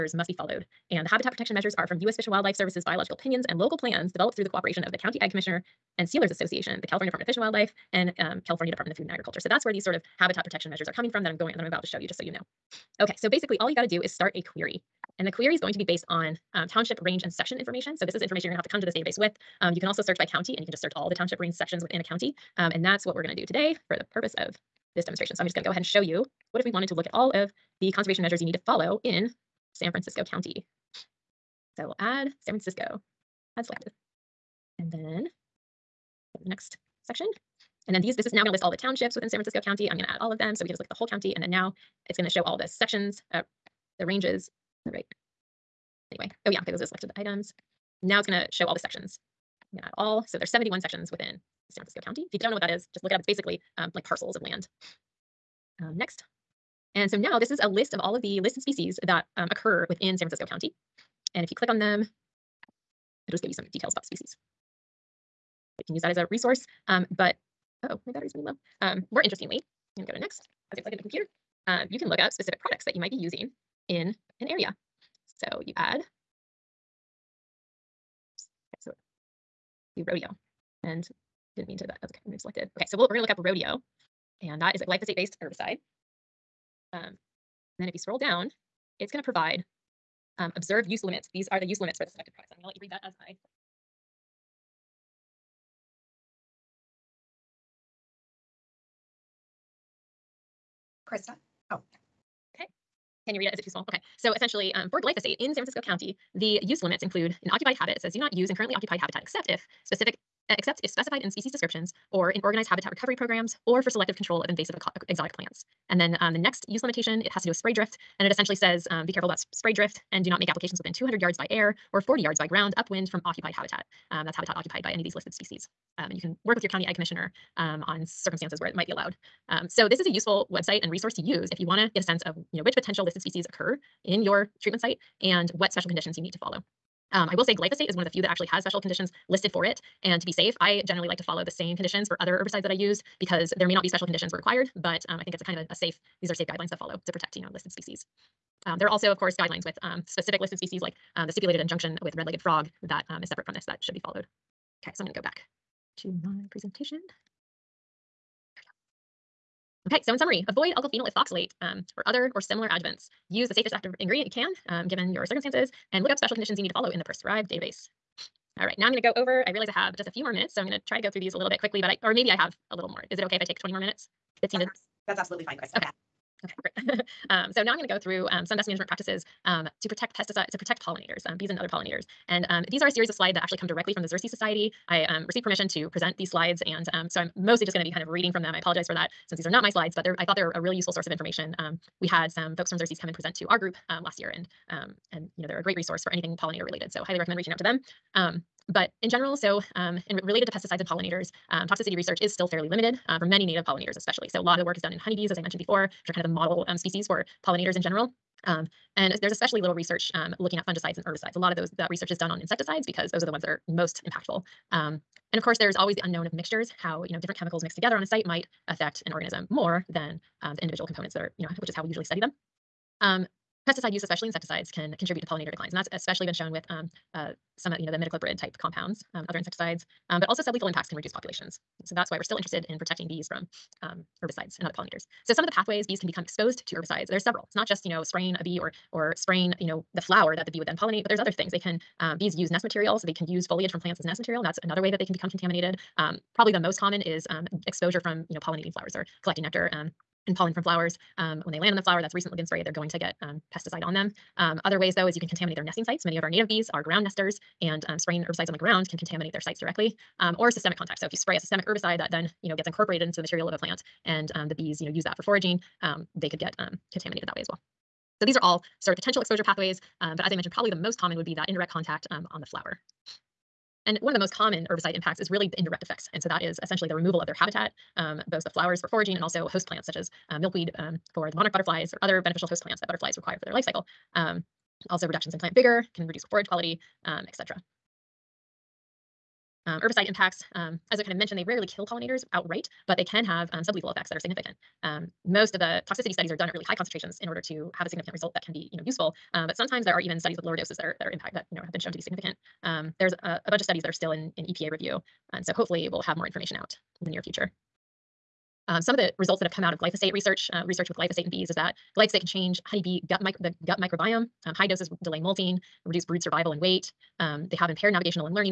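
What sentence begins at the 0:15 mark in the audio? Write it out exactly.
And the query is going to be based on um, township range and section information.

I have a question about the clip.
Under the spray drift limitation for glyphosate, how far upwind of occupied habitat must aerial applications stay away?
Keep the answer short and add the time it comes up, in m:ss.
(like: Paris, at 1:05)
200 yards, at 2:00.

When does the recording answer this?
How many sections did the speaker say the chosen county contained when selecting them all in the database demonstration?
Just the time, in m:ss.
0:50.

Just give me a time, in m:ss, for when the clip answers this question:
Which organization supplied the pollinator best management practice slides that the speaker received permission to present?
3:04.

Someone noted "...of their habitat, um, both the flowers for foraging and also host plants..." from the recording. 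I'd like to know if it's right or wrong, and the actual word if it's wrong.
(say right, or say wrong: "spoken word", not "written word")
right.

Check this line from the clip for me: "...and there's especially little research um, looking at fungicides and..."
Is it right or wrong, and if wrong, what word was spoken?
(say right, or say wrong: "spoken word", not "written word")
right.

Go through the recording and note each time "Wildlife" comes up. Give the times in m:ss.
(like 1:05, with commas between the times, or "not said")
0:02, 0:07.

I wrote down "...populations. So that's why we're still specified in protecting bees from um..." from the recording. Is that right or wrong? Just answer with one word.
wrong.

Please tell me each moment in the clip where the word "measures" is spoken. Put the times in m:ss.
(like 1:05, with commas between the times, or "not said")
0:01, 0:10, 0:28.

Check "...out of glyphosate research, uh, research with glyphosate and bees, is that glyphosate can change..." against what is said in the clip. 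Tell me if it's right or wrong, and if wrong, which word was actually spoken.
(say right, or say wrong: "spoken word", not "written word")
right.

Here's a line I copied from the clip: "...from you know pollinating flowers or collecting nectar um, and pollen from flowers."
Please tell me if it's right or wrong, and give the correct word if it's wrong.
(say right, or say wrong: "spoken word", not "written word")
right.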